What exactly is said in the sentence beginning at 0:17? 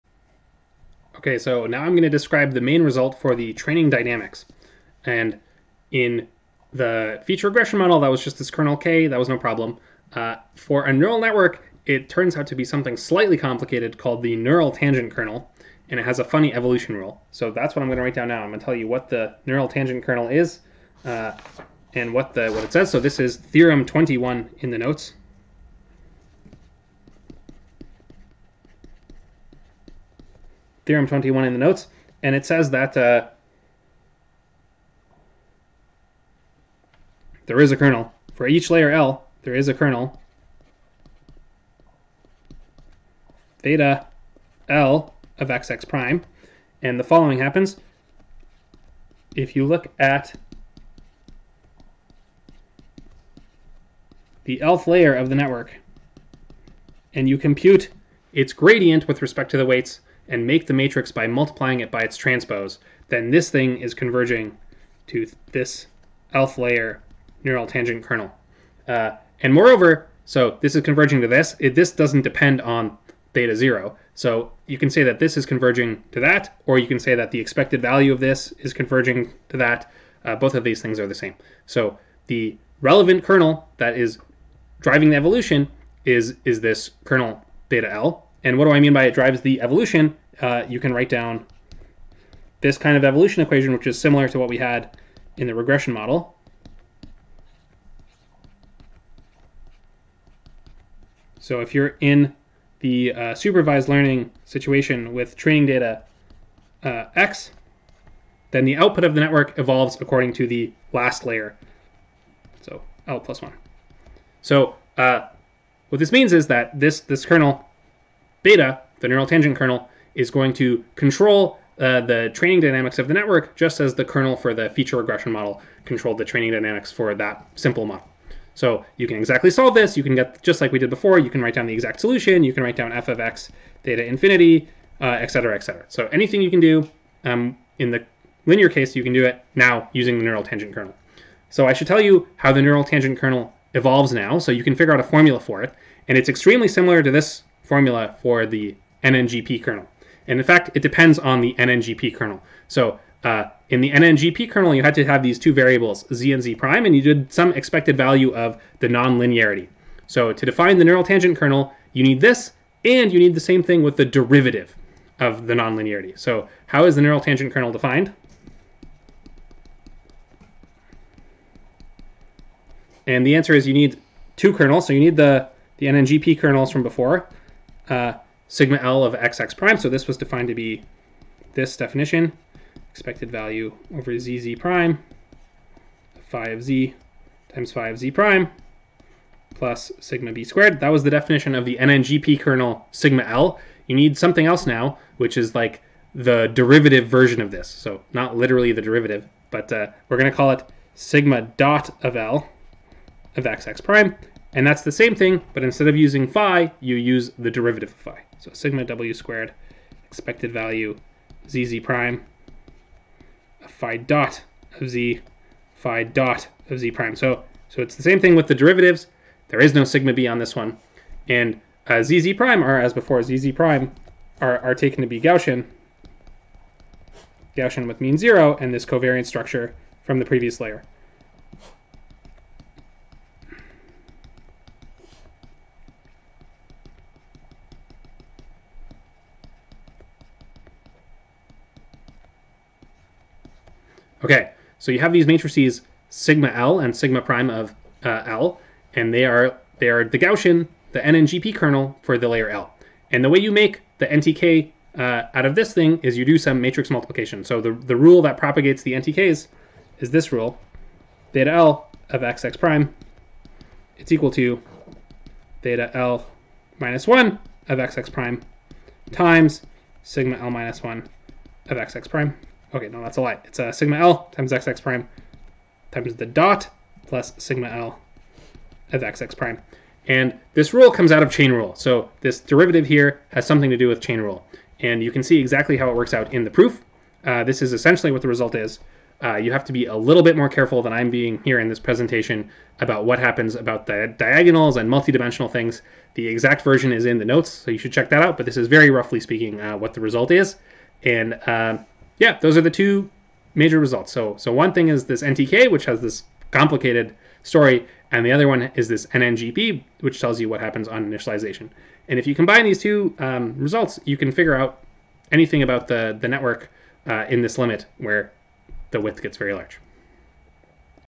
So that's what I'm going to write down now.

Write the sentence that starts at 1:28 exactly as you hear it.
And what do I mean by it drives the evolution?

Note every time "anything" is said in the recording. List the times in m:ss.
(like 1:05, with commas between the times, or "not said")
2:16, 5:15.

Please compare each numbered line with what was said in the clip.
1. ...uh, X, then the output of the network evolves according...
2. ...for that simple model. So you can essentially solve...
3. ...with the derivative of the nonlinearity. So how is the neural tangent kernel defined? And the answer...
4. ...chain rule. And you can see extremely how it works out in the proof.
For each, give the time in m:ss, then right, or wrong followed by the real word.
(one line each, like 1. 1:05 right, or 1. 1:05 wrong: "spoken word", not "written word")
1. 1:46 right
2. 2:06 wrong: "exactly", not "essentially"
3. 2:43 right
4. 4:43 wrong: "exactly", not "extremely".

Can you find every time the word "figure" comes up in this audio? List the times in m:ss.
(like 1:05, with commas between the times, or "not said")
2:24, 5:14.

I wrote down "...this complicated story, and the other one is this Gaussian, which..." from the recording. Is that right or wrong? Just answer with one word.
wrong.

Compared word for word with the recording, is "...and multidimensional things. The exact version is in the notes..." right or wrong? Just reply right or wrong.
right.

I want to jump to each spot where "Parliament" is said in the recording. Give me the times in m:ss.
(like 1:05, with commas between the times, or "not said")
not said.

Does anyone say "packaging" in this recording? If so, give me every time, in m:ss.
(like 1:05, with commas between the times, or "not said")
not said.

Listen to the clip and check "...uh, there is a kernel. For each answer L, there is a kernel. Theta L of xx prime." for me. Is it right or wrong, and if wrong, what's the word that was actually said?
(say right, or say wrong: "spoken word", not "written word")
wrong: "layer", not "answer".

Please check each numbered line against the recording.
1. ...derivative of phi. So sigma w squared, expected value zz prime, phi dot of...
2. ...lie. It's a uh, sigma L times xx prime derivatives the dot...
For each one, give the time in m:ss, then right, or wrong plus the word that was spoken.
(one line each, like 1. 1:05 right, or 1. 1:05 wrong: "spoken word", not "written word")
1. 3:27 right
2. 4:33 wrong: "times", not "derivatives".